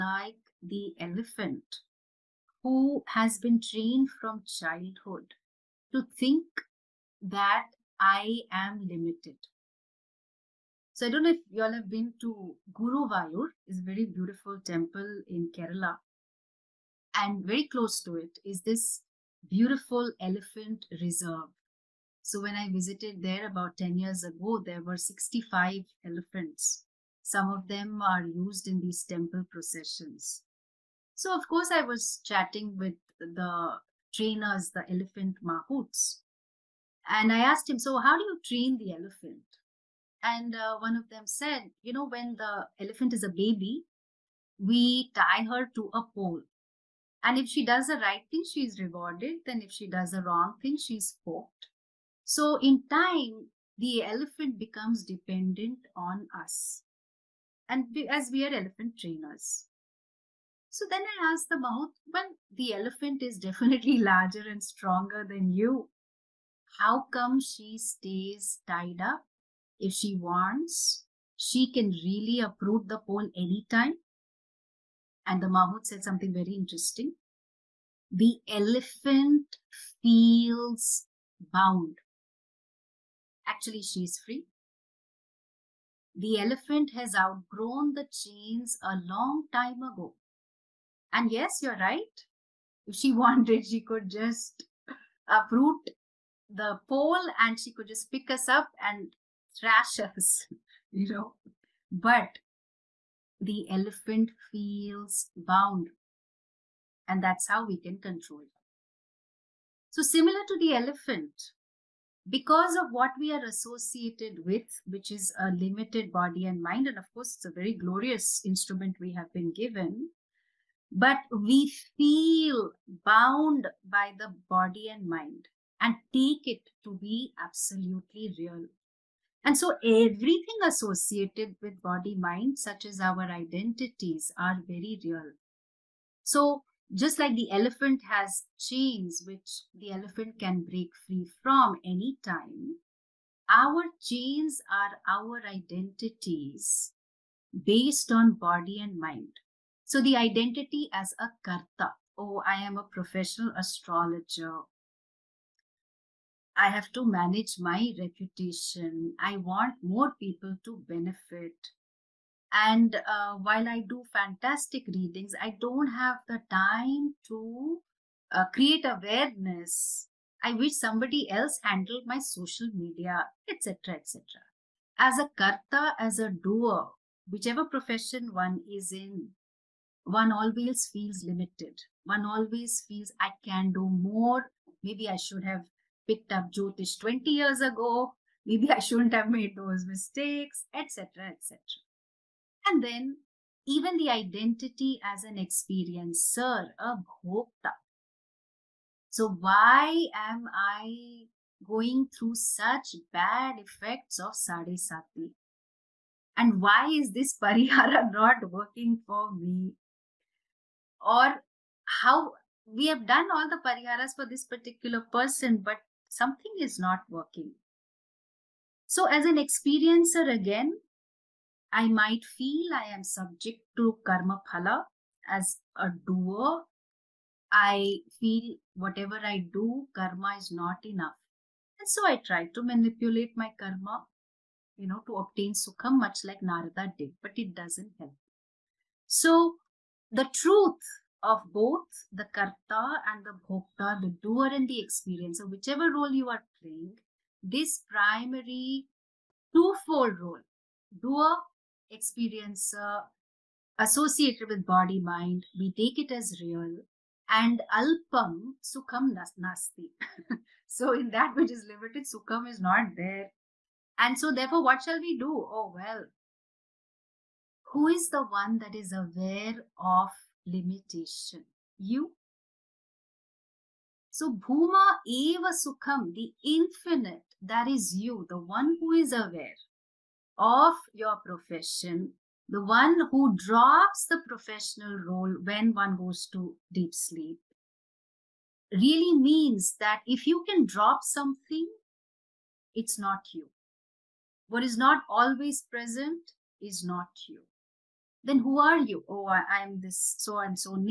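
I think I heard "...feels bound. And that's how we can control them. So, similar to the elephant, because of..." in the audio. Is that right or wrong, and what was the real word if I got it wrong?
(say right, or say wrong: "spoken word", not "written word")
right.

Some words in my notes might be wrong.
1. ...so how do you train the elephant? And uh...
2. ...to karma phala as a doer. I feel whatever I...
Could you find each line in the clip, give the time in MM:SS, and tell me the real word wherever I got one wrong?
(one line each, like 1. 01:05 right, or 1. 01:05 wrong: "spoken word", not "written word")
1. 00:37 right
2. 03:43 right.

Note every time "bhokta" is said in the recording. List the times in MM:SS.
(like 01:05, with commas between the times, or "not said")
03:17, 04:03.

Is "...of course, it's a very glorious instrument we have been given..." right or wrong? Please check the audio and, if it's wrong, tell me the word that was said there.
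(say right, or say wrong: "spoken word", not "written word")
right.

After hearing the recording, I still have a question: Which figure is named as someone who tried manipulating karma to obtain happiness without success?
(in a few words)
Narada.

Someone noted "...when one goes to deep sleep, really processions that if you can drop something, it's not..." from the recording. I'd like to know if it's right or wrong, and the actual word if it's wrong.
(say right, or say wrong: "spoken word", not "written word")
wrong: "means", not "processions".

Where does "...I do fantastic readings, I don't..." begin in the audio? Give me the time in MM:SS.
02:43.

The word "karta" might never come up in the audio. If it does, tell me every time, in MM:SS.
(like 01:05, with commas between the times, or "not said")
02:31, 02:55, 04:02.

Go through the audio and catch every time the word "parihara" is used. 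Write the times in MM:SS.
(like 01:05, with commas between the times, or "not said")
03:27, 03:33.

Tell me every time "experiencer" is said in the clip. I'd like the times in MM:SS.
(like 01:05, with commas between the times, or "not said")
03:15, 03:39, 04:04, 04:11.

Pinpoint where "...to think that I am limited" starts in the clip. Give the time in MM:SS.
00:05.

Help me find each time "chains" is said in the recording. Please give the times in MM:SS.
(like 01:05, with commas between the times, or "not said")
01:28, 02:18, 02:24.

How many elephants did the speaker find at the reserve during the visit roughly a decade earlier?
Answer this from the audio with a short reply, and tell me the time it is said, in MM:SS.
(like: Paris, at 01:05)
65, at 00:24.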